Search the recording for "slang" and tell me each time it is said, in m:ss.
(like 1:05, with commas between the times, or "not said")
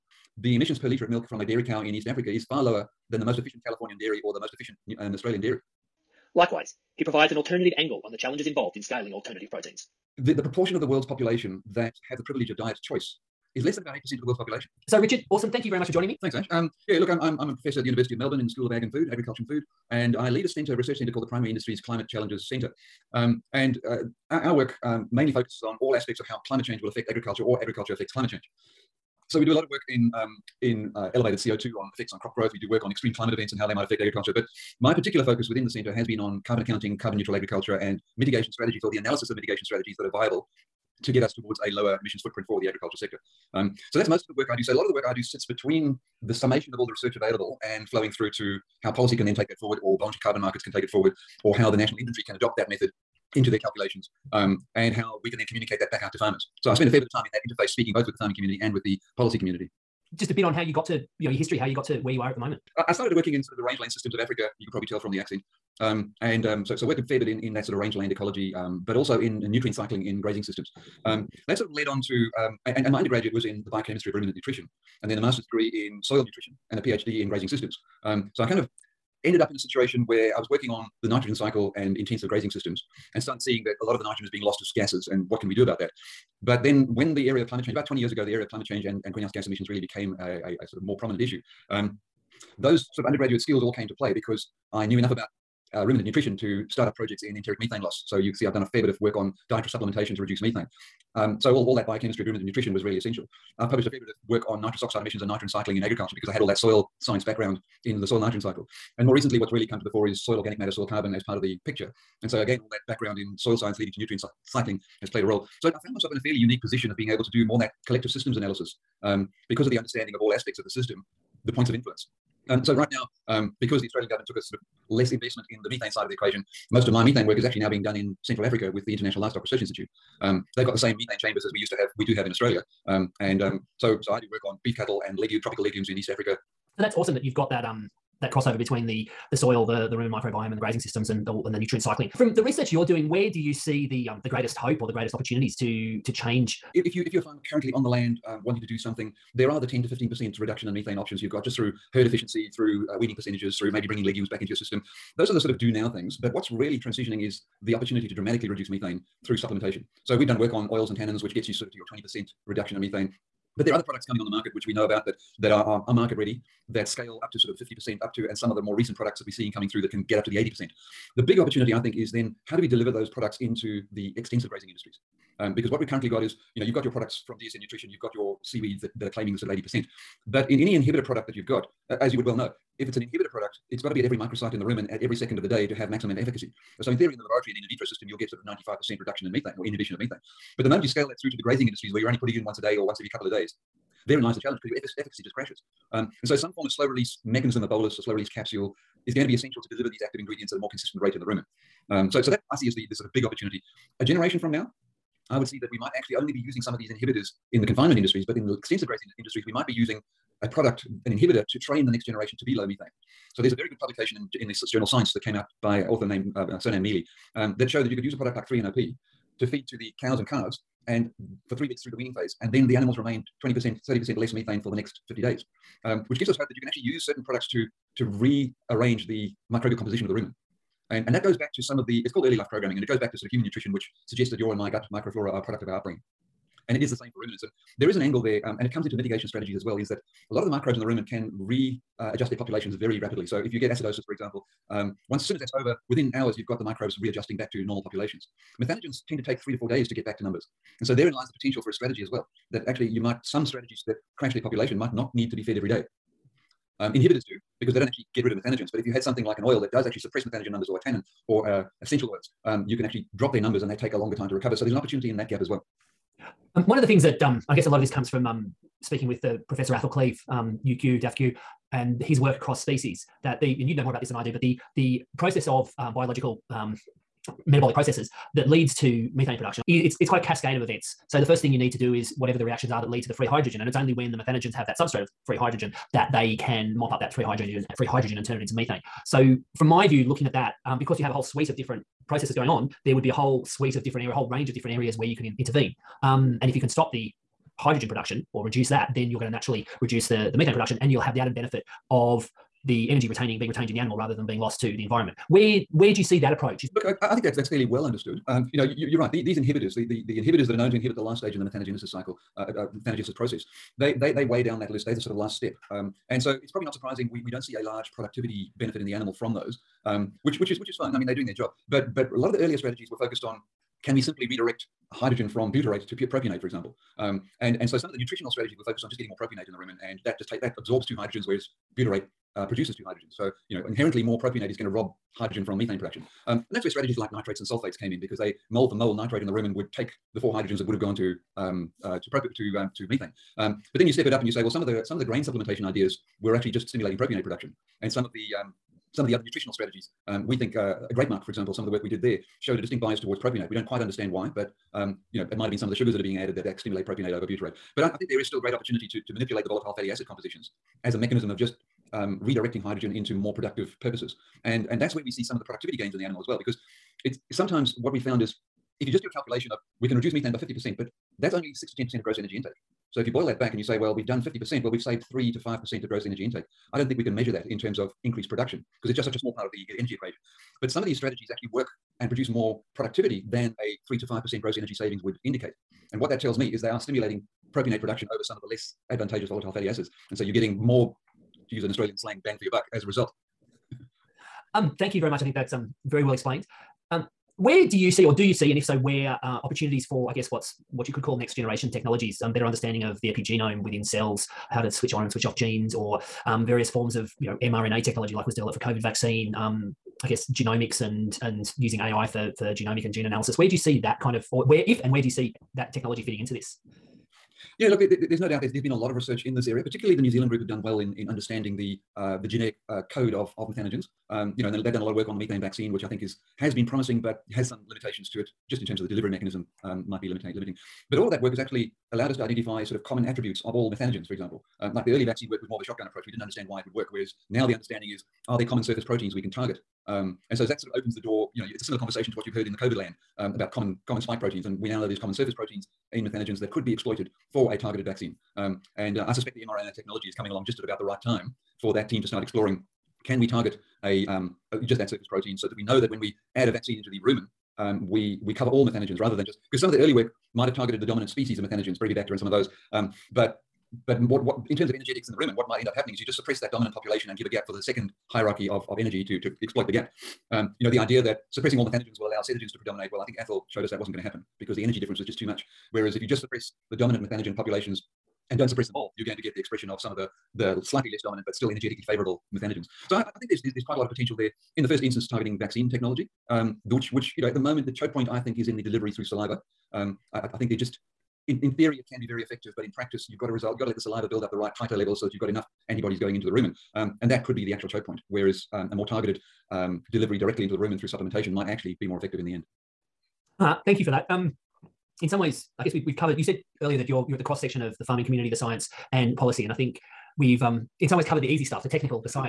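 6:31.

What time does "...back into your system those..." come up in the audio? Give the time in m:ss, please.
2:34.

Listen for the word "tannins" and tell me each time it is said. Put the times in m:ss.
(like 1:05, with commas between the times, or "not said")
2:40, 4:20.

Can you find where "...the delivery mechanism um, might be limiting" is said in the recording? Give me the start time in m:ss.
7:08.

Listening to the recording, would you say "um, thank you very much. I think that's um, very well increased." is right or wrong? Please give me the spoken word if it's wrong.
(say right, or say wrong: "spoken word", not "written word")
wrong: "explained", not "increased".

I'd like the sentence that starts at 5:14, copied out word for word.
They're the sort of last step.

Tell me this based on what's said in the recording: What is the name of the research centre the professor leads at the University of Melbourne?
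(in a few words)
Primary Industries Climate Challenges Centre.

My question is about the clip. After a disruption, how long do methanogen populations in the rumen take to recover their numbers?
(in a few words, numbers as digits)
3 to 4 days.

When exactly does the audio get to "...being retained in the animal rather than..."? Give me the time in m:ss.
5:03.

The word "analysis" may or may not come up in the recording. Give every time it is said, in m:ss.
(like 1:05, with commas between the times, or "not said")
0:38, 1:58, 6:53.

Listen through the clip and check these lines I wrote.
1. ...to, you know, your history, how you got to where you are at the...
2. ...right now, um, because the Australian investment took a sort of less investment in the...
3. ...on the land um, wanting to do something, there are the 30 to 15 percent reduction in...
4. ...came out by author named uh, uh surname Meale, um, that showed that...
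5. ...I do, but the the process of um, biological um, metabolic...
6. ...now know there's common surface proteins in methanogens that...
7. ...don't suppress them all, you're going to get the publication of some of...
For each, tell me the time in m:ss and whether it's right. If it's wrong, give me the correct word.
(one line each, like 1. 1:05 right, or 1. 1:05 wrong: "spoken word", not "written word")
1. 1:00 right
2. 2:02 wrong: "government", not "investment"
3. 2:27 wrong: "10", not "30"
4. 3:35 right
5. 4:34 right
6. 7:24 right
7. 7:58 wrong: "expression", not "publication".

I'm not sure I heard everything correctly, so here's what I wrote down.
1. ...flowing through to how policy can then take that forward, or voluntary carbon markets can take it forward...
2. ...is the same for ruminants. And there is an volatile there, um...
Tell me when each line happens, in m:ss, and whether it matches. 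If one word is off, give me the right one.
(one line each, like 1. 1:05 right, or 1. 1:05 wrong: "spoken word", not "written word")
1. 0:47 right
2. 3:56 wrong: "angle", not "volatile".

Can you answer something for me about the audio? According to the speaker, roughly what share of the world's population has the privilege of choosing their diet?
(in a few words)
8%.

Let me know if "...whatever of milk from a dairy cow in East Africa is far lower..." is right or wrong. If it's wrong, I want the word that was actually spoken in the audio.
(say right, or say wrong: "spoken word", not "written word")
wrong: "liter", not "whatever".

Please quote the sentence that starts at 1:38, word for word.
So you see, I've done a fair bit of work on dietary supplementation to reduce methane.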